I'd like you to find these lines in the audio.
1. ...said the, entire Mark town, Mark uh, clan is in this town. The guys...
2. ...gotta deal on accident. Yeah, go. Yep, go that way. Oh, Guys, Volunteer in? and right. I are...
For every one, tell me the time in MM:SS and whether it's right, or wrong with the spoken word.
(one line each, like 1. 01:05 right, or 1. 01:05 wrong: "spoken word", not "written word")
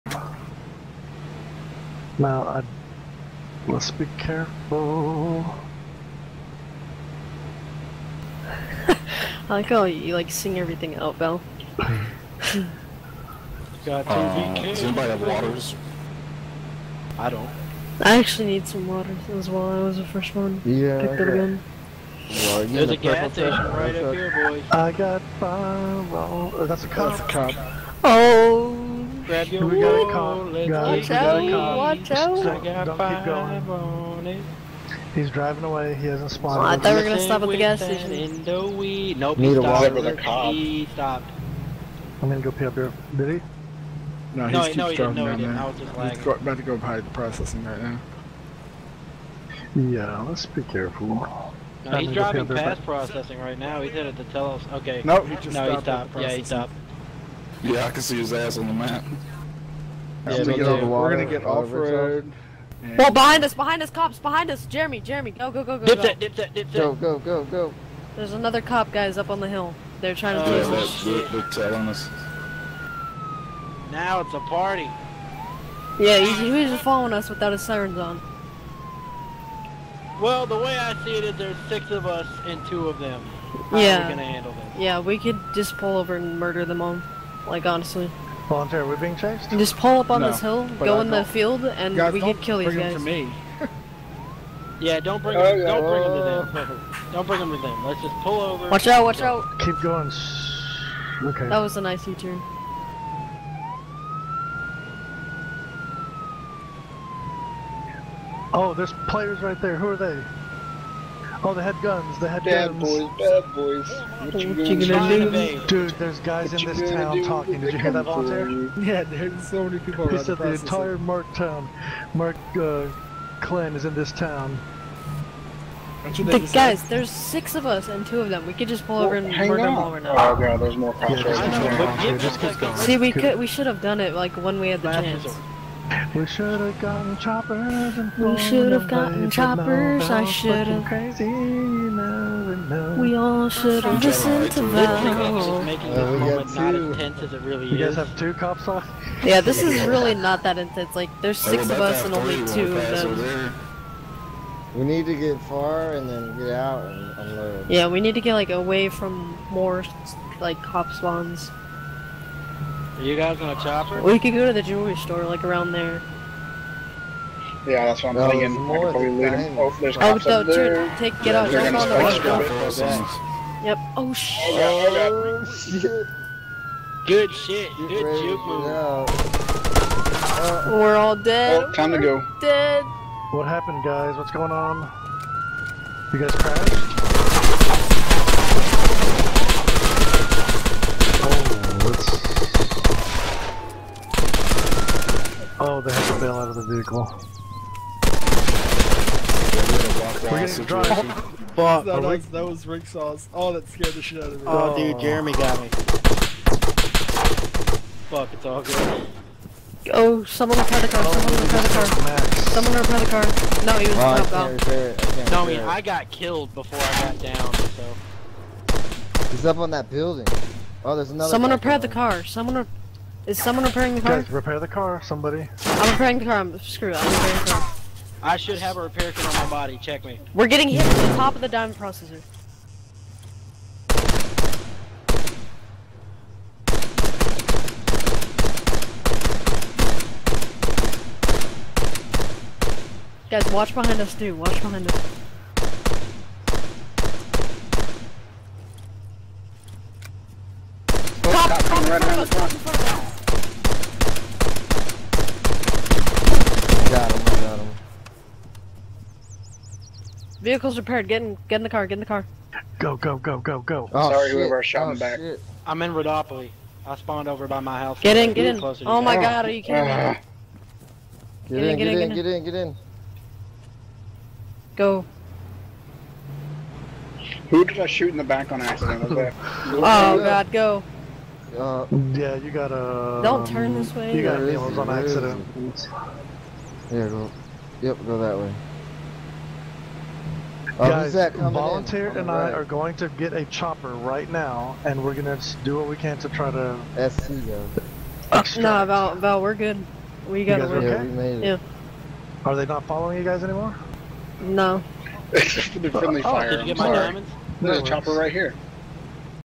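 1. 02:00 right
2. 04:44 right.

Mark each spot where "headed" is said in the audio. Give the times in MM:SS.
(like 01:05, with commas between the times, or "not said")
00:53.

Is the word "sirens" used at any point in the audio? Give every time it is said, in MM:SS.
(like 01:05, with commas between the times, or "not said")
01:17.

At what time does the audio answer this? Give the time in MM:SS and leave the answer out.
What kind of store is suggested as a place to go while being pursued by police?
02:44.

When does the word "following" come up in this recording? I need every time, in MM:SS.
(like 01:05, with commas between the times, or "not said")
01:16, 05:02.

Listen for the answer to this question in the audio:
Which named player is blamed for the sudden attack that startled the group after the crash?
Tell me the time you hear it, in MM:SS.
03:22.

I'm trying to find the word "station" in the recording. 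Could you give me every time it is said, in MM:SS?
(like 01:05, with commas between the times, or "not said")
00:23, 00:37.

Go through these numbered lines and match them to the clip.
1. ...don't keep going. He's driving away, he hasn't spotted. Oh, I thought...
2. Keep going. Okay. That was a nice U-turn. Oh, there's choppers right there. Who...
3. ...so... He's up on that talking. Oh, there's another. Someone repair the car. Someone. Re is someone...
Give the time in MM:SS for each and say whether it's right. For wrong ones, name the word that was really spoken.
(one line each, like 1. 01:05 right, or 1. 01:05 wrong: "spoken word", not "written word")
1. 00:32 right
2. 01:39 wrong: "players", not "choppers"
3. 03:37 wrong: "building", not "talking".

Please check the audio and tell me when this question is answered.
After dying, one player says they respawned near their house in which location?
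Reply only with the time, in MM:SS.
04:25.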